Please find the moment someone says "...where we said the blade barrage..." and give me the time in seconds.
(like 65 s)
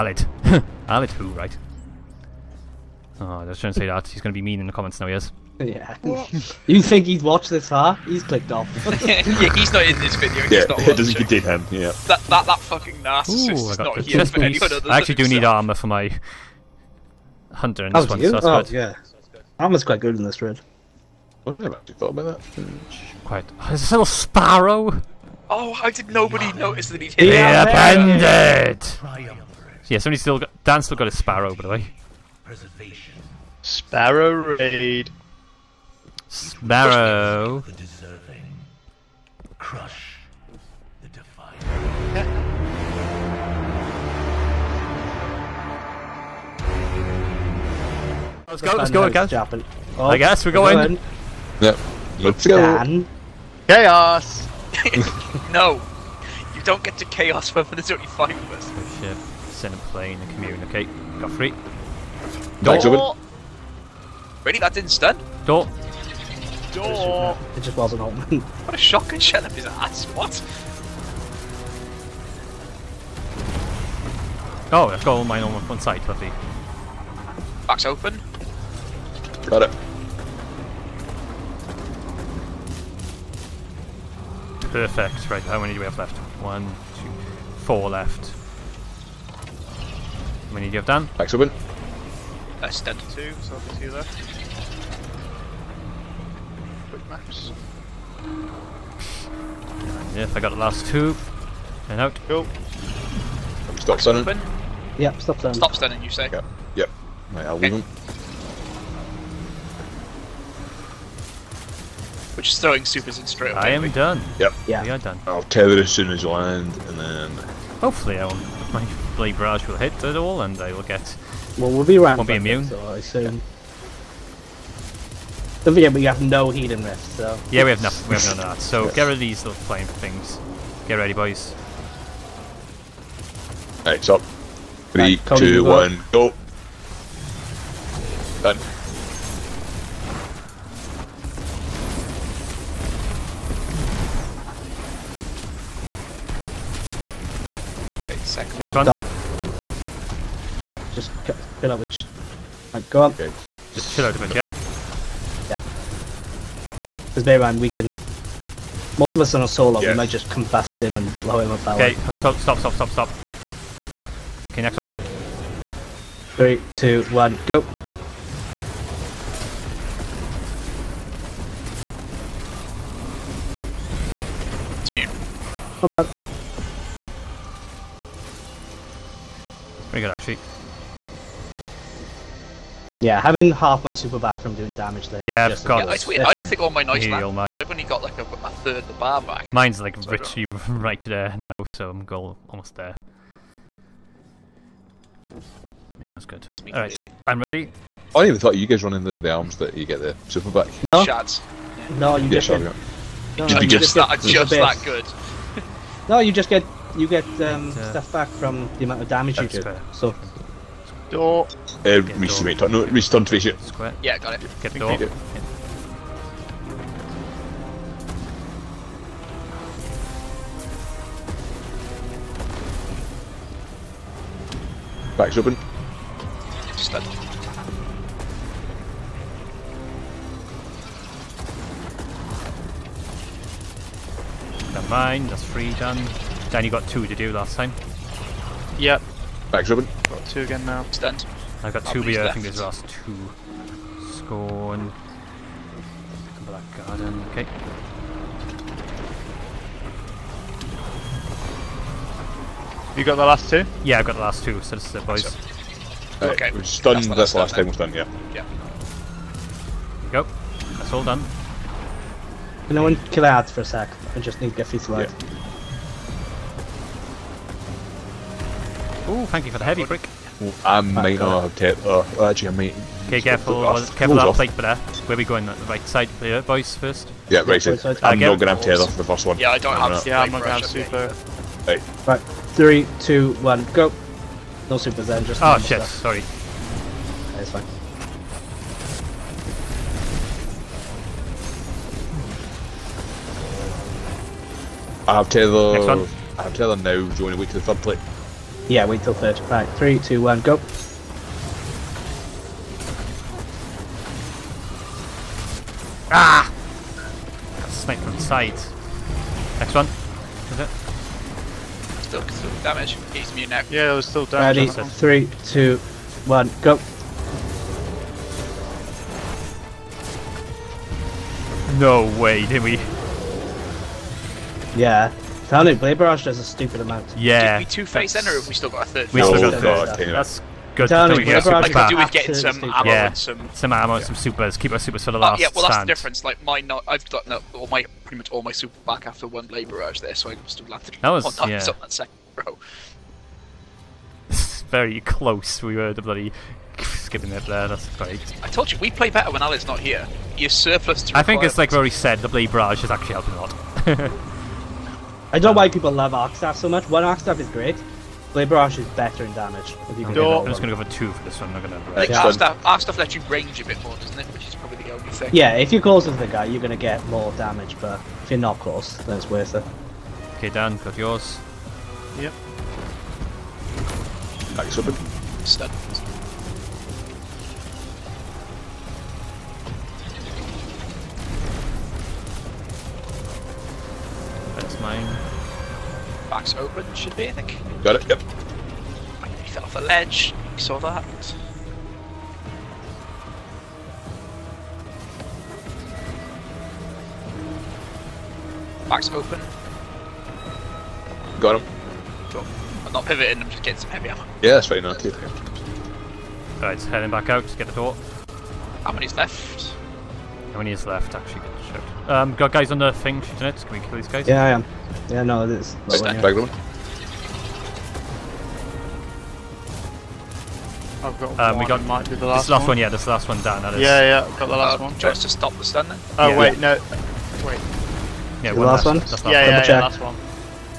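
351 s.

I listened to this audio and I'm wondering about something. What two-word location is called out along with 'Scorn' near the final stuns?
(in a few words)
Black Garden.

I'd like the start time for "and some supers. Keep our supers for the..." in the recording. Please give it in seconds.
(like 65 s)
333 s.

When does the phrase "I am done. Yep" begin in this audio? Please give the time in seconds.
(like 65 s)
113 s.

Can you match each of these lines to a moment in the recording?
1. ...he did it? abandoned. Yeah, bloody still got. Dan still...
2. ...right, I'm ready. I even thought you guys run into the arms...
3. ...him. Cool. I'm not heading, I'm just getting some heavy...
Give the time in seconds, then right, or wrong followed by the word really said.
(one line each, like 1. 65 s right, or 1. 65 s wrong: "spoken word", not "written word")
1. 27 s wrong: "somebody", not "bloody"
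2. 196 s right
3. 401 s wrong: "pivoting", not "heading".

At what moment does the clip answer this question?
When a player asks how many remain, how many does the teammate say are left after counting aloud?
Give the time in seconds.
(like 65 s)
87 s.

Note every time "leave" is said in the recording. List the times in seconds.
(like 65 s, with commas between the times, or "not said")
107 s.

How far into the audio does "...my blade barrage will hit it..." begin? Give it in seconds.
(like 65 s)
118 s.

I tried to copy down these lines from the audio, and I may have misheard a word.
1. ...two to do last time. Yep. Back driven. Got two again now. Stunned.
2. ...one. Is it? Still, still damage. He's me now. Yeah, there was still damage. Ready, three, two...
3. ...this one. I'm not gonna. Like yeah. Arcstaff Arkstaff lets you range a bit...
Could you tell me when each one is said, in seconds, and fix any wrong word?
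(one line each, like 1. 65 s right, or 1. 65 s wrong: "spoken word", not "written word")
1. 236 s right
2. 309 s right
3. 361 s right.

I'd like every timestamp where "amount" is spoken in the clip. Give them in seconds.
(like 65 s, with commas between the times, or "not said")
208 s, 326 s.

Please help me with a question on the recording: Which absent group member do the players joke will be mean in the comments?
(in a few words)
Alid.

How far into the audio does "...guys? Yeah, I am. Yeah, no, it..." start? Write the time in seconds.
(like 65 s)
414 s.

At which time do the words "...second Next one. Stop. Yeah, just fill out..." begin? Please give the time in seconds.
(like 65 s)
148 s.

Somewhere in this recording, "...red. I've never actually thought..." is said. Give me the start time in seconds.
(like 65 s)
20 s.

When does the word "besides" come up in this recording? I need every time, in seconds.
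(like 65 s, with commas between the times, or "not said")
not said.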